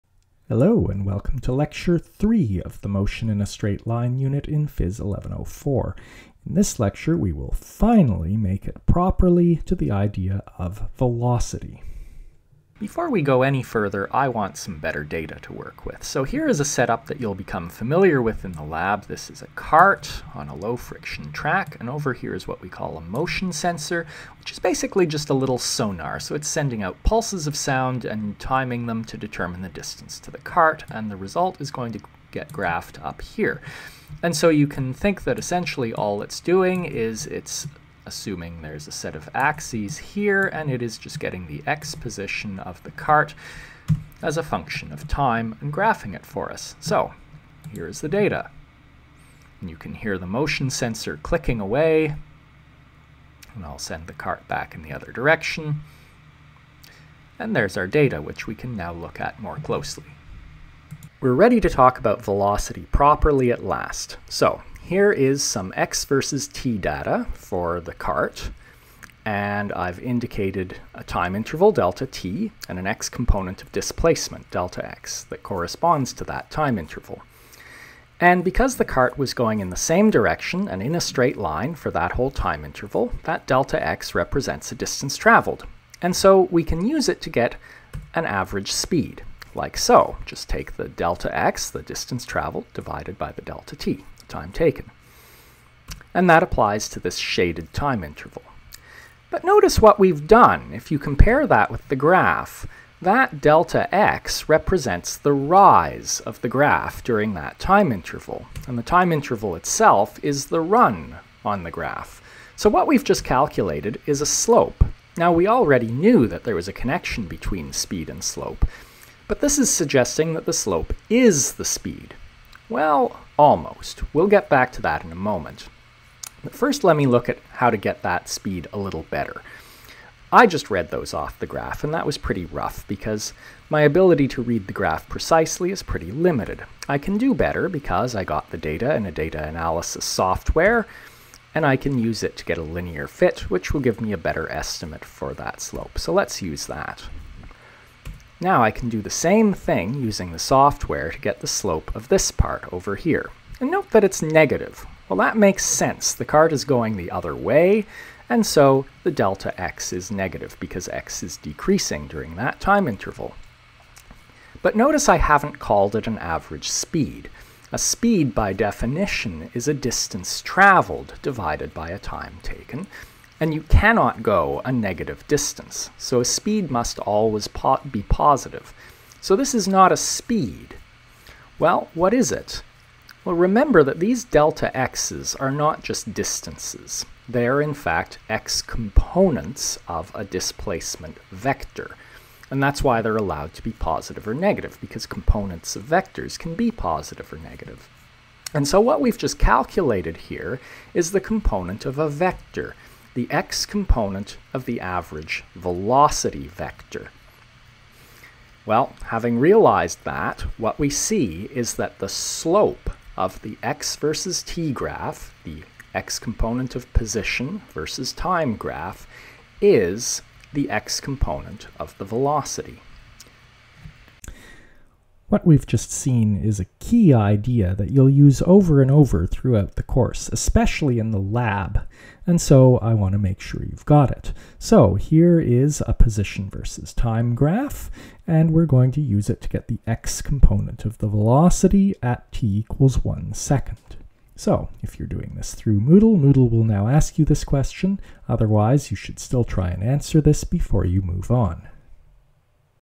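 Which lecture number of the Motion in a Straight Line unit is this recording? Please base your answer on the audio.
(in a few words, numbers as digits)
3.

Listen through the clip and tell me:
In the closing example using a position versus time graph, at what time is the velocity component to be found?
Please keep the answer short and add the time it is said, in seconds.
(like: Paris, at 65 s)
1 second, at 243 s.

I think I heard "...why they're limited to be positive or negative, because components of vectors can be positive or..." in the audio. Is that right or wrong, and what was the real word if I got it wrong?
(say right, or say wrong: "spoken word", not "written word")
wrong: "allowed", not "limited".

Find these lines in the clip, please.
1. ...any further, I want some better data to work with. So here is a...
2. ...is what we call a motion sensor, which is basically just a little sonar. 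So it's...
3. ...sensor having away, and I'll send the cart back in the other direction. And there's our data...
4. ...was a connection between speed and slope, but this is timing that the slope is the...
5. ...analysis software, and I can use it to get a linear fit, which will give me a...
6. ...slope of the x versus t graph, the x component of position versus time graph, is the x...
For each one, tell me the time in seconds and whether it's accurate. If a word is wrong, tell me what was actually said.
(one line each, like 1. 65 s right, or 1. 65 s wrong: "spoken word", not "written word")
1. 13 s right
2. 22 s right
3. 50 s wrong: "clicking", not "having"
4. 116 s wrong: "suggesting", not "timing"
5. 139 s right
6. 212 s right.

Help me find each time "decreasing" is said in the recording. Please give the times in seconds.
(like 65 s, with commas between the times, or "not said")
161 s.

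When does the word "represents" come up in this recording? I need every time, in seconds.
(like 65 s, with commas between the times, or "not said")
84 s, 104 s.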